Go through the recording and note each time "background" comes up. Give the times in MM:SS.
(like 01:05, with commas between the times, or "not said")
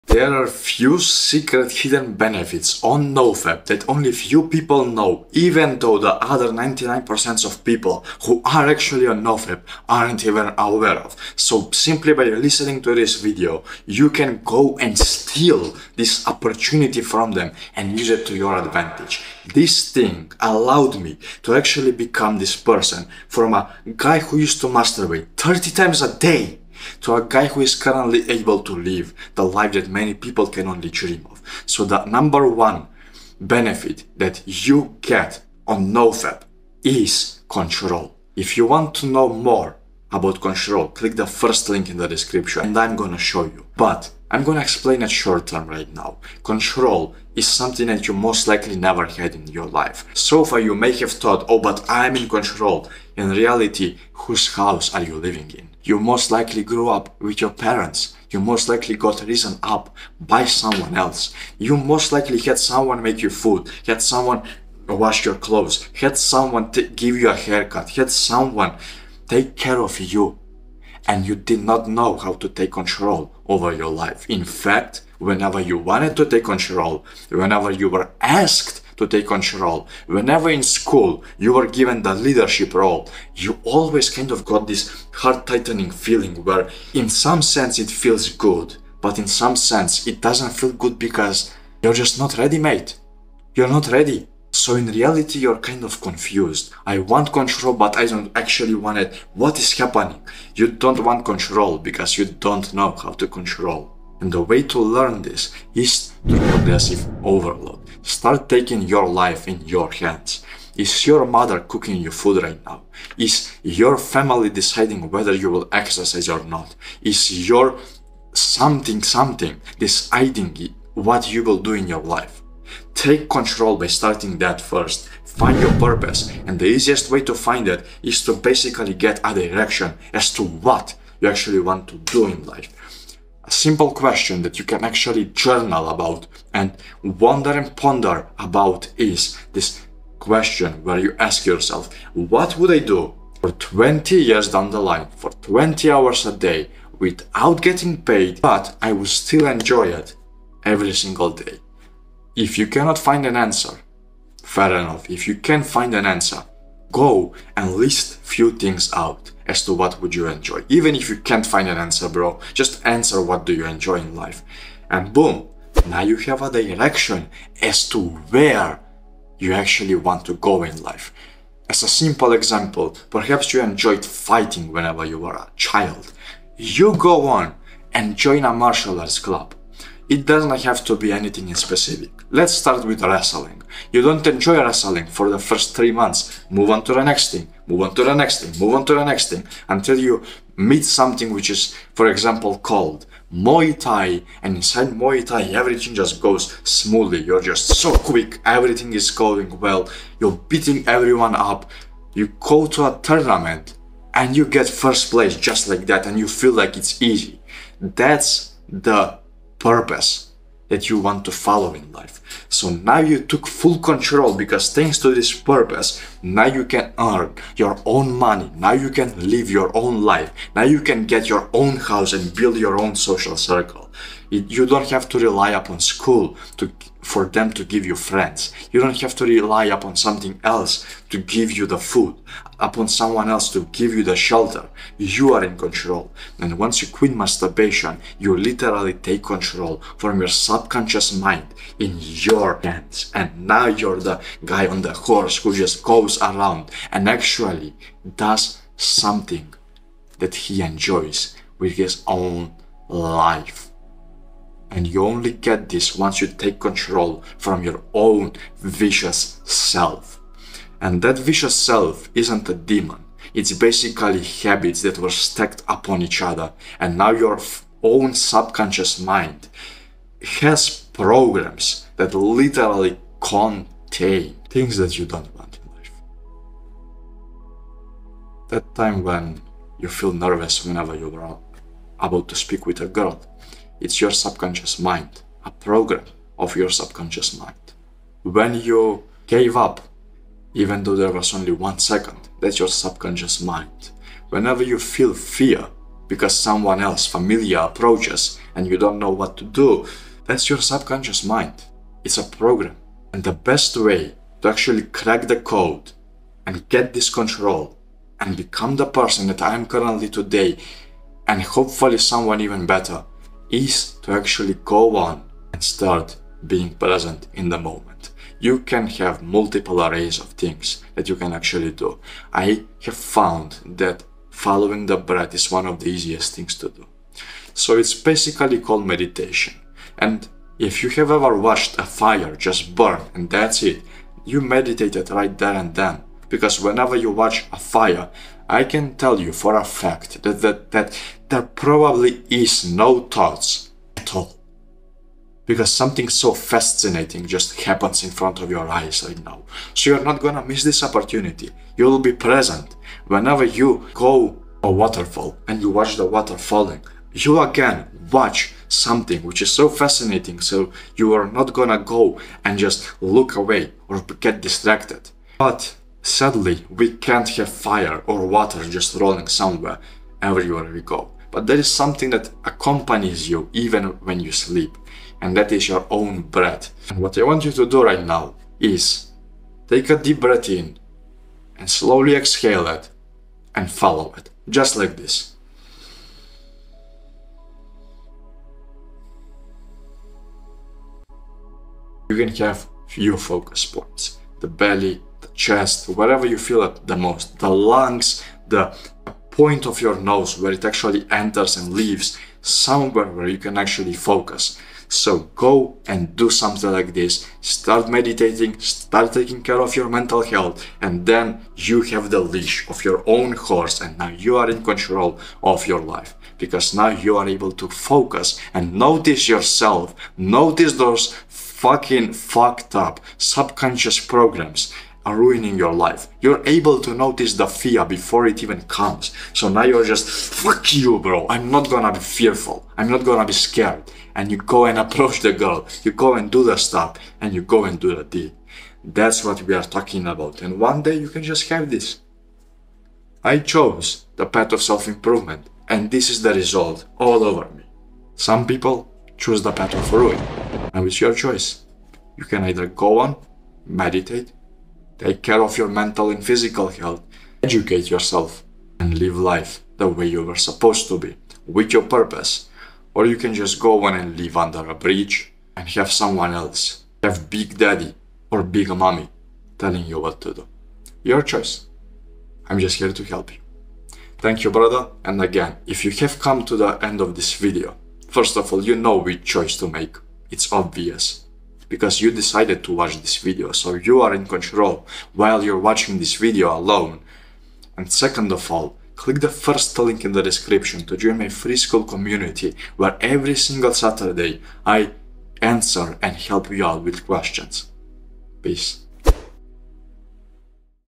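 not said.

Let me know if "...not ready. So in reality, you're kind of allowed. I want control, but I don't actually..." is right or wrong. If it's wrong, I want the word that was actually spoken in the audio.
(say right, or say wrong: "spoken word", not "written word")
wrong: "confused", not "allowed".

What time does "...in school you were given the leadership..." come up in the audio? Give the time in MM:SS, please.
01:20.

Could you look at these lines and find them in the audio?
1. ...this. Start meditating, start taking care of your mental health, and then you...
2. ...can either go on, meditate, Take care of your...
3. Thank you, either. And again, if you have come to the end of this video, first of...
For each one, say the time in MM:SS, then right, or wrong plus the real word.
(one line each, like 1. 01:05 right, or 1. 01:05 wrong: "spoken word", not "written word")
1. 06:46 right
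2. 07:32 right
3. 07:54 wrong: "brother", not "either".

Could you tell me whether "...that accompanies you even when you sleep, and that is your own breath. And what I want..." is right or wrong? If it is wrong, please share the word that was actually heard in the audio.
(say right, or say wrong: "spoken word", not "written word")
right.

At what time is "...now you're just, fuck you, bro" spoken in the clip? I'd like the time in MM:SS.
07:09.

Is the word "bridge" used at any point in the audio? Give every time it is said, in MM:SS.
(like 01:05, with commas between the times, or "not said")
07:44.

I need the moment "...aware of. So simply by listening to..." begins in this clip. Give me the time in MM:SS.
00:10.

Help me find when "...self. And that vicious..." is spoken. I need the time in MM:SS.
04:19.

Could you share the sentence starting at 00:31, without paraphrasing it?
So the number one benefit that you get on NoFap is control.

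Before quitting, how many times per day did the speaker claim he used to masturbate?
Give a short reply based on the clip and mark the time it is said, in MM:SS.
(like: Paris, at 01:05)
30, at 00:25.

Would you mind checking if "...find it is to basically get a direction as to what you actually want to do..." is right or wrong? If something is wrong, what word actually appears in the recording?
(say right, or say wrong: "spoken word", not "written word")
right.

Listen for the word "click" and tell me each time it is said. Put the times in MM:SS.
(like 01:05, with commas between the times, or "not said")
00:40, 08:08.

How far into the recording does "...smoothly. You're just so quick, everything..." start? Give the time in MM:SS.
03:16.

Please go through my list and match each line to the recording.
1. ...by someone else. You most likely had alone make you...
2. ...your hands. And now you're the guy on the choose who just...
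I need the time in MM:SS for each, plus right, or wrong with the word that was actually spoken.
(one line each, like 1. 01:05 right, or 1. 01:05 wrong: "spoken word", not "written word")
1. 01:00 wrong: "someone", not "alone"
2. 04:01 wrong: "horse", not "choose".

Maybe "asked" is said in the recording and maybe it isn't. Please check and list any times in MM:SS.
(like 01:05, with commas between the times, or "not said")
01:18.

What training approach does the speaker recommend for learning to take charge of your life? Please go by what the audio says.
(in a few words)
Progressive overload.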